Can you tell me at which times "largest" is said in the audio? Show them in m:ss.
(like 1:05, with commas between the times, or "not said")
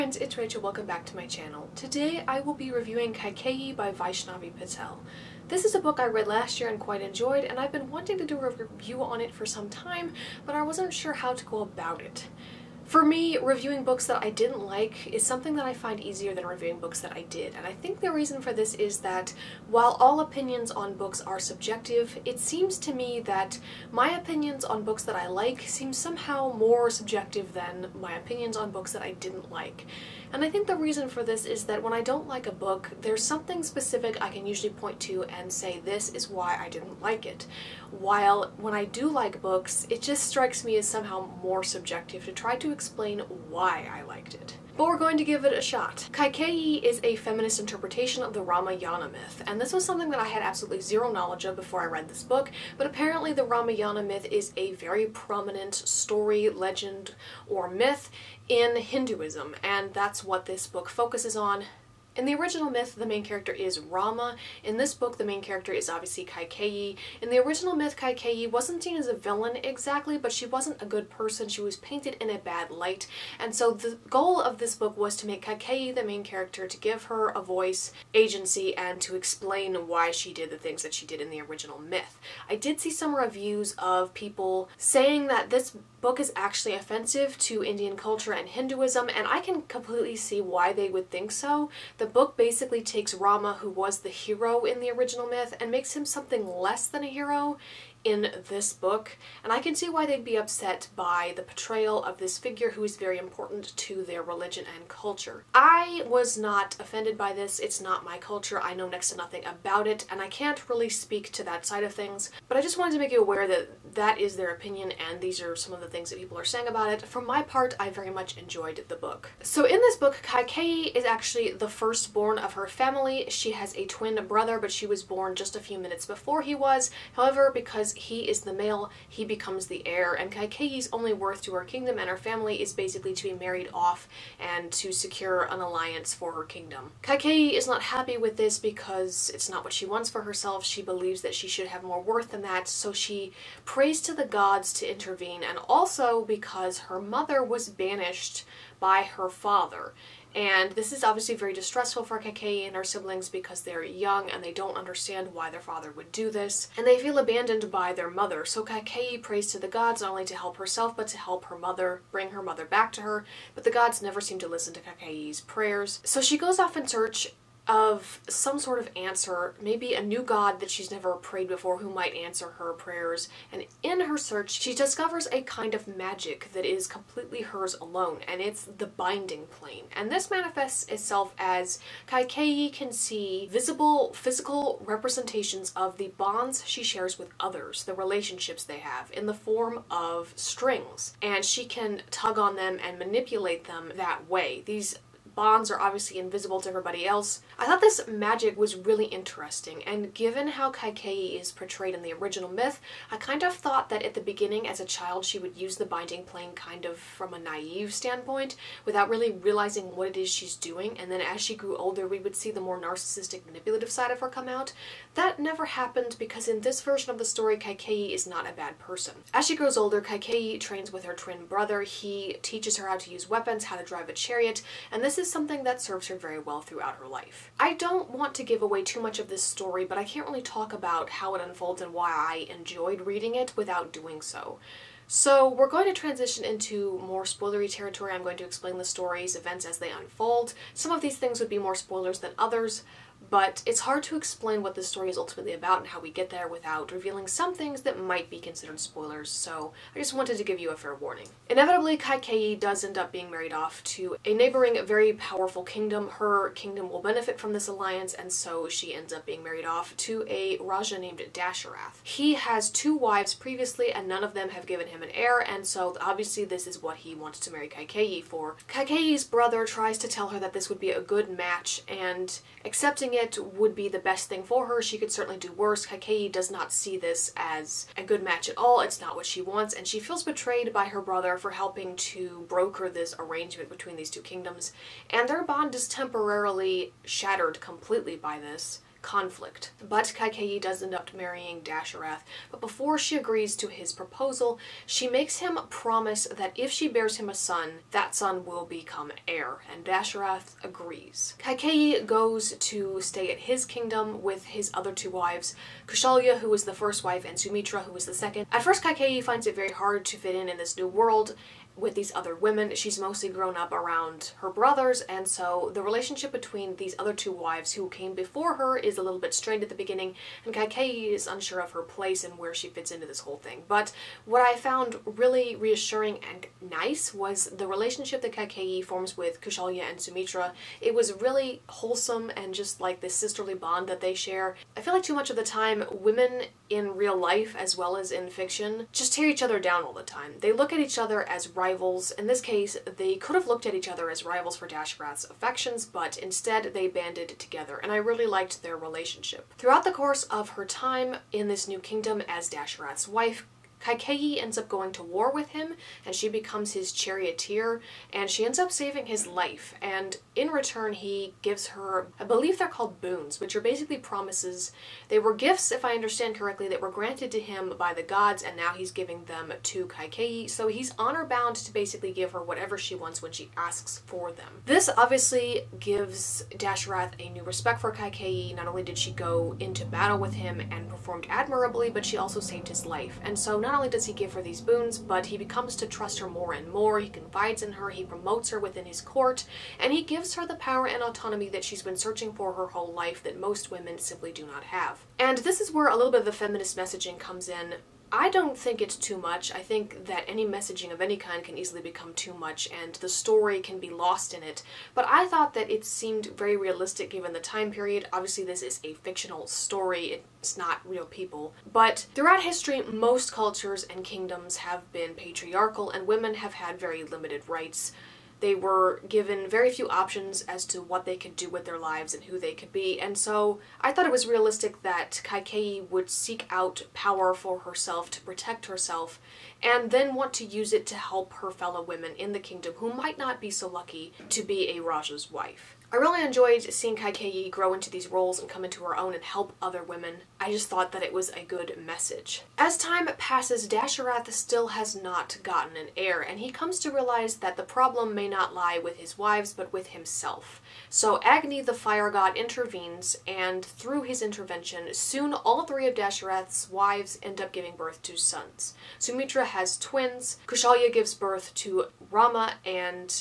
not said.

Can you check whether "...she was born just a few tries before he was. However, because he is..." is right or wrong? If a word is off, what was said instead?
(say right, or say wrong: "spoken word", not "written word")
wrong: "minutes", not "tries".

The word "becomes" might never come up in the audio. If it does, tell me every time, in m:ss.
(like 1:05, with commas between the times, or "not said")
2:09, 4:58, 5:56, 6:25, 6:41.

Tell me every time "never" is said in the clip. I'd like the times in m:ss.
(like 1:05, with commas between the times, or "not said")
2:44, 2:50, 3:35.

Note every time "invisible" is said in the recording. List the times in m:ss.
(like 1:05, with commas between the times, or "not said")
3:16.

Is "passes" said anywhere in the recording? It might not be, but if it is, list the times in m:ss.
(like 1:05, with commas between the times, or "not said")
7:23.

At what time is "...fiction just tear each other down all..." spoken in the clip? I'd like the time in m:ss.
5:38.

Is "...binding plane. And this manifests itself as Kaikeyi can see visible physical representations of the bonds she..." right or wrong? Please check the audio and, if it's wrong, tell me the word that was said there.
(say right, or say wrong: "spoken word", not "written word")
right.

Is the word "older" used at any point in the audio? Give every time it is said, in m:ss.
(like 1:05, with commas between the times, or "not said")
3:31, 3:39.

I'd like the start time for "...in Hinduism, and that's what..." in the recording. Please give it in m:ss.
0:58.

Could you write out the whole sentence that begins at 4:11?
Inevitably, Kaikeyi does end up being married off to a neighboring very powerful kingdom.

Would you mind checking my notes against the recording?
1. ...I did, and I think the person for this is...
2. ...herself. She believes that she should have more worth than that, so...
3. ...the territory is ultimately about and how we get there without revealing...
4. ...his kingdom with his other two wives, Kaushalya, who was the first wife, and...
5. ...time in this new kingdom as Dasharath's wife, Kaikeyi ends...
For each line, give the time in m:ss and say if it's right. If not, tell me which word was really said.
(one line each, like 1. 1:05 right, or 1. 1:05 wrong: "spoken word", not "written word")
1. 0:17 wrong: "reason", not "person"
2. 2:20 right
3. 4:04 wrong: "story", not "territory"
4. 5:03 right
5. 5:50 right.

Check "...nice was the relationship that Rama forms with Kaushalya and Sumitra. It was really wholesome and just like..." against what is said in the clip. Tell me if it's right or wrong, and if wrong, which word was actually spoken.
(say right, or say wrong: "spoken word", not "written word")
wrong: "Kaikeyi", not "Rama".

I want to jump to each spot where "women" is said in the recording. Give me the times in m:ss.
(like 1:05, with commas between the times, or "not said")
5:12, 5:35, 6:33, 6:56, 7:11, 7:19.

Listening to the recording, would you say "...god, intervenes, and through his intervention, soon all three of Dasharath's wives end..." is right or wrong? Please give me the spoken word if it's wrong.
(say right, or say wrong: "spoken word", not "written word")
right.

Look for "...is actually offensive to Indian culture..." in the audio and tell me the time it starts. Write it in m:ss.
1:26.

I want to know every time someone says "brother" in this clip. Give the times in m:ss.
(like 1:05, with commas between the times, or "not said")
2:04, 3:41, 4:29, 4:41, 5:14.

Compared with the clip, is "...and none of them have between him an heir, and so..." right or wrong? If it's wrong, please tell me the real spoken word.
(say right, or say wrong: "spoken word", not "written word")
wrong: "given", not "between".